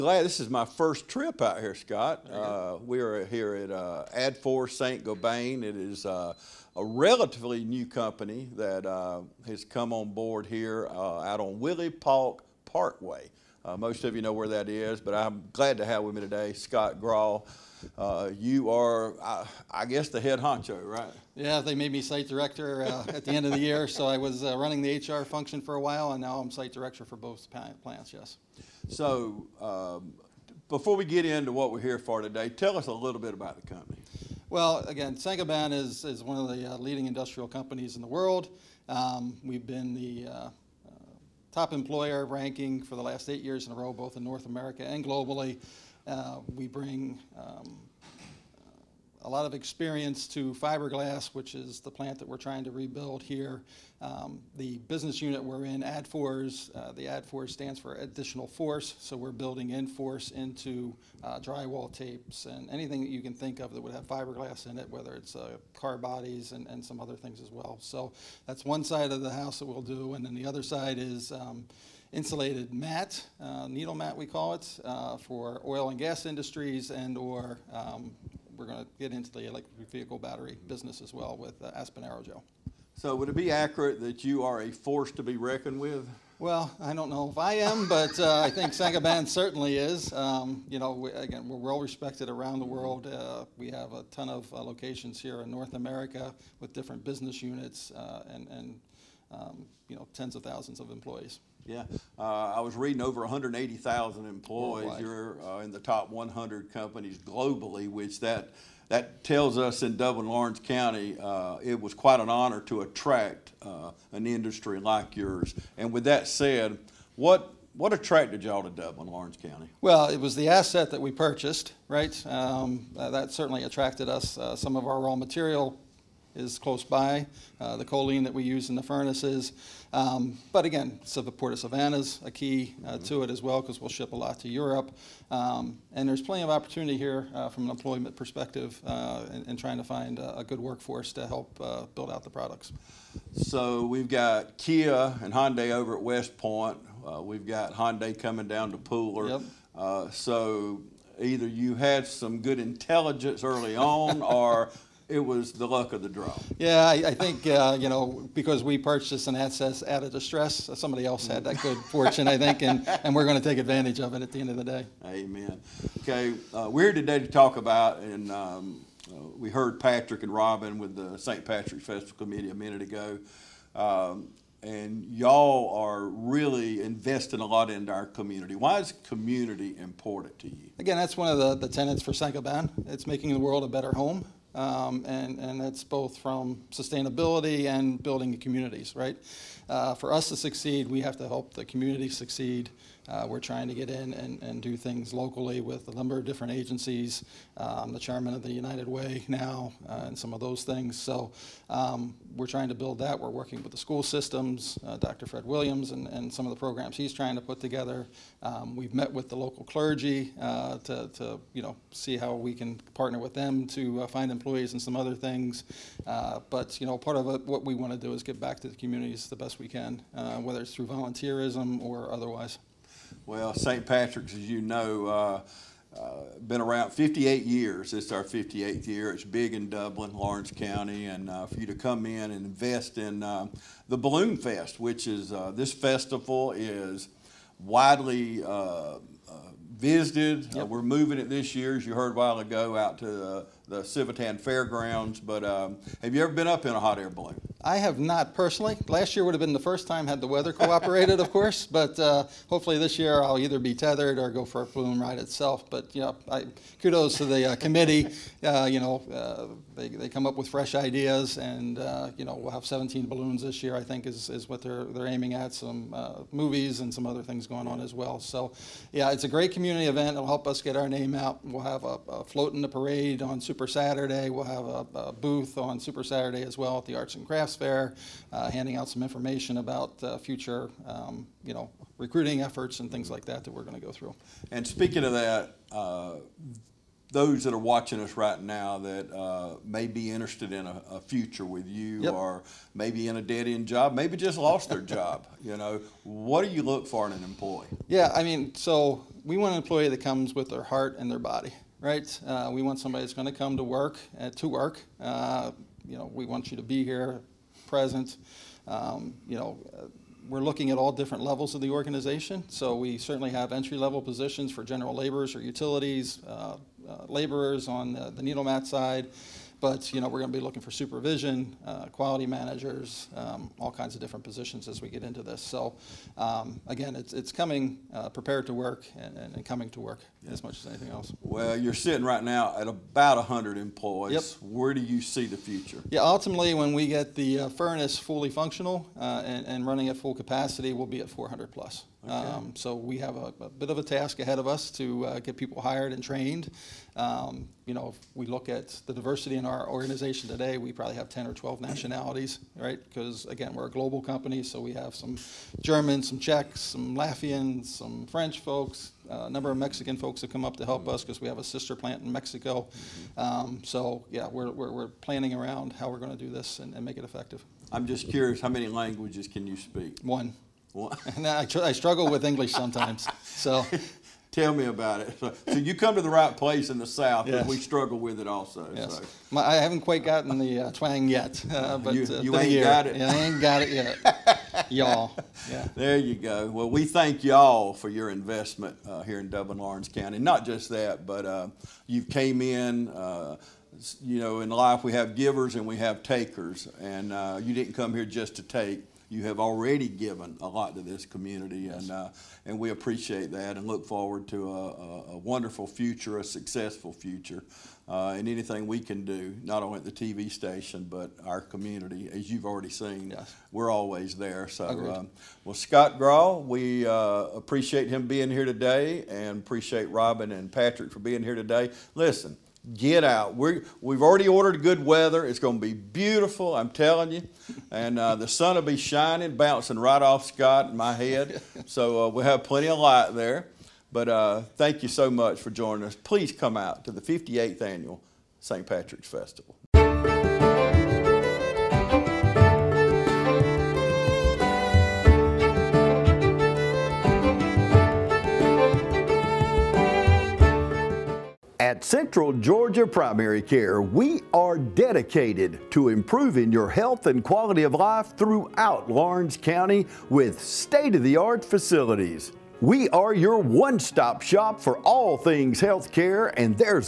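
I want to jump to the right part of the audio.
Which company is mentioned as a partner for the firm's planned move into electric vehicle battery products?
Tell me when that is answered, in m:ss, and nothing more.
1:21.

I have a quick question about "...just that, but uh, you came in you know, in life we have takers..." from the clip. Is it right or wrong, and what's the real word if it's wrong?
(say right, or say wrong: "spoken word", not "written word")
wrong: "givers", not "takers".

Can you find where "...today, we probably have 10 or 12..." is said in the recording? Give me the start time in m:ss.
5:50.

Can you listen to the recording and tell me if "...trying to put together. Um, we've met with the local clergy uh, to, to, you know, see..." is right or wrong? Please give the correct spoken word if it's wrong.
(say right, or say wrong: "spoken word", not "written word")
right.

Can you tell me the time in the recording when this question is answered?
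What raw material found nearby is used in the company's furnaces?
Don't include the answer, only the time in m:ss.
2:07.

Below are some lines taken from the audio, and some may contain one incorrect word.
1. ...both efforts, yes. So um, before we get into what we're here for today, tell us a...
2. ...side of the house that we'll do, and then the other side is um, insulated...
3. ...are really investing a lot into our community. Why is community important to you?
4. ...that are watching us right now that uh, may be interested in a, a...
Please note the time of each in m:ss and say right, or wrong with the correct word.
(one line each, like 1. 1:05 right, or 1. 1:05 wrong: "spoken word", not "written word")
1. 0:27 wrong: "plants", not "efforts"
2. 1:08 right
3. 2:55 right
4. 4:47 right.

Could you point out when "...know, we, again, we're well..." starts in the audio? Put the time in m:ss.
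1:30.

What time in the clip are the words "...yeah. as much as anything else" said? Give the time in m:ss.
5:30.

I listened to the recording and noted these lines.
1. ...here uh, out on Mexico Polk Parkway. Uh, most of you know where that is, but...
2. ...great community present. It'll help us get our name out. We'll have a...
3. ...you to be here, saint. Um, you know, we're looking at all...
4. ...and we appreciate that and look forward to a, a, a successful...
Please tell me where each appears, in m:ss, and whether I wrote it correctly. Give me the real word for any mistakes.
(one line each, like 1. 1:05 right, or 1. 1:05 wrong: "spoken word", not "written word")
1. 0:10 wrong: "Willie", not "Mexico"
2. 4:29 wrong: "event", not "present"
3. 5:06 wrong: "present", not "saint"
4. 6:42 wrong: "wonderful", not "successful".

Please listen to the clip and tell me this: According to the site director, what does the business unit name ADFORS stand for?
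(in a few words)
additional force.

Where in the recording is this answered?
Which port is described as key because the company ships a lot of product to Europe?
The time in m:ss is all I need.
2:11.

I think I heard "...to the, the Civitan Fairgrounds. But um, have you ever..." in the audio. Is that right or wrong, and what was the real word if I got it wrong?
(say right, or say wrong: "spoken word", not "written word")
right.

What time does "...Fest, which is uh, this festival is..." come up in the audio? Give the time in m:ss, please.
3:54.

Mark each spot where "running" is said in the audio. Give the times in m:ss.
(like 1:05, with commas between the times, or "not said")
0:24, 5:39.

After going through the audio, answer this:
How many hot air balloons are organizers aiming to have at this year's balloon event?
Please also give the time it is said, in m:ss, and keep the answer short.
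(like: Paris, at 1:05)
17, at 4:22.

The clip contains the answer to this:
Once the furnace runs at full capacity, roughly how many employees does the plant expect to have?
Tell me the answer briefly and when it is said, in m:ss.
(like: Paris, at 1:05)
400 plus, at 5:41.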